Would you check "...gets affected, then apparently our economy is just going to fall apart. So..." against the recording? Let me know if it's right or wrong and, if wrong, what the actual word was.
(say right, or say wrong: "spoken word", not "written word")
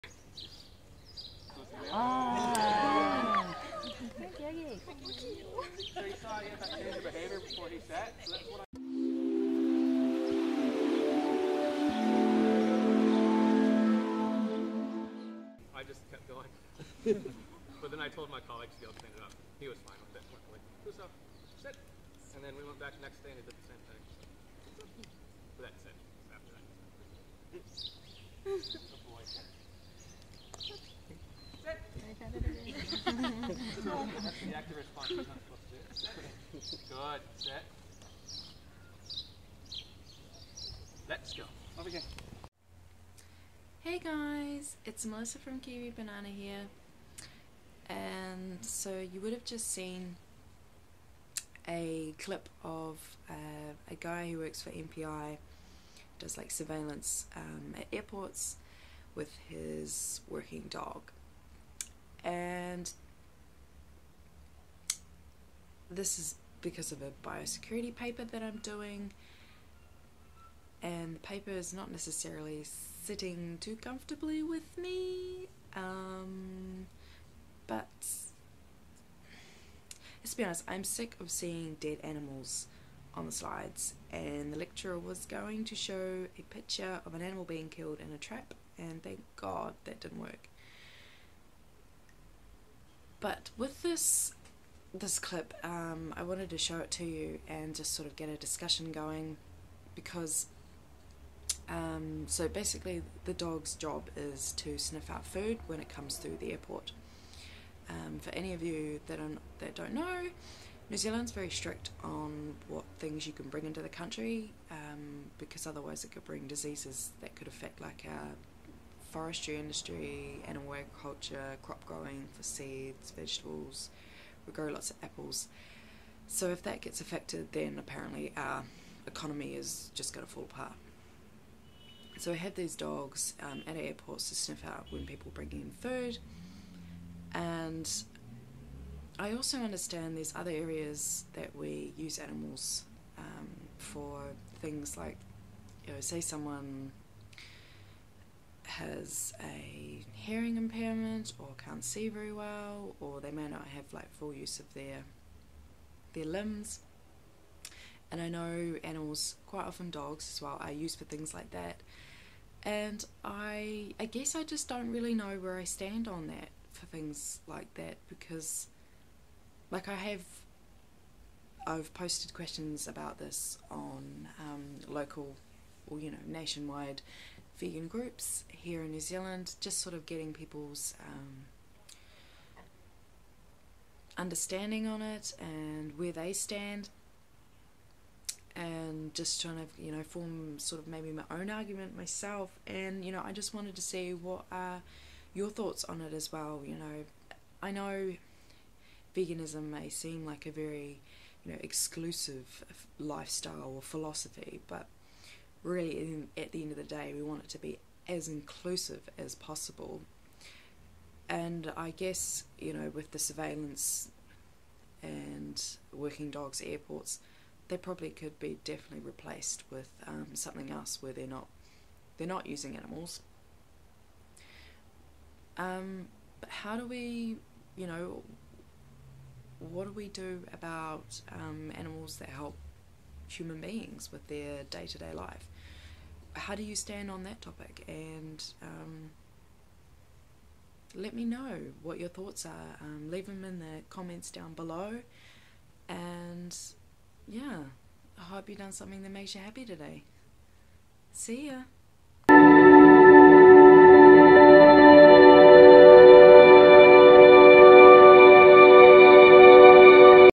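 right.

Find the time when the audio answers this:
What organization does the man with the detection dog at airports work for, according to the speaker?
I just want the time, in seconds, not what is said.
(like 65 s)
54 s.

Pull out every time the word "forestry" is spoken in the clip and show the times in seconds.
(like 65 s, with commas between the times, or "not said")
119 s.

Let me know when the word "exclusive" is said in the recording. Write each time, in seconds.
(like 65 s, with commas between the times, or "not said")
201 s.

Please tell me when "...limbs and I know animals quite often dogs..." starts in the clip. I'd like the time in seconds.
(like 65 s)
156 s.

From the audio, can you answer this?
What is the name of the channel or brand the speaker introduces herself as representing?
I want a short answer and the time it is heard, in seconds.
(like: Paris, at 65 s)
Kiwi Banana, at 45 s.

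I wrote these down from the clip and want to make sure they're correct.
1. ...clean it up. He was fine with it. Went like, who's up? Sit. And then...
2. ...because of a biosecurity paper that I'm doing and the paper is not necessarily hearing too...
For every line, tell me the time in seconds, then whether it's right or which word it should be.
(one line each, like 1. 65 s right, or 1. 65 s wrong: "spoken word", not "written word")
1. 18 s right
2. 66 s wrong: "sitting", not "hearing".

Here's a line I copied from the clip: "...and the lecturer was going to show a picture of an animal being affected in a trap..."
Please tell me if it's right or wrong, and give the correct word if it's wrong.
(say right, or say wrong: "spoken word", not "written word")
wrong: "killed", not "affected".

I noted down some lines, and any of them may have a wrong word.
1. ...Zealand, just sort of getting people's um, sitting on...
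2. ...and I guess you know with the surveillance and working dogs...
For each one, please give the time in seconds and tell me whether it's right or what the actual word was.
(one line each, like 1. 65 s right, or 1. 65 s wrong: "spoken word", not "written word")
1. 178 s wrong: "understanding", not "sitting"
2. 211 s right.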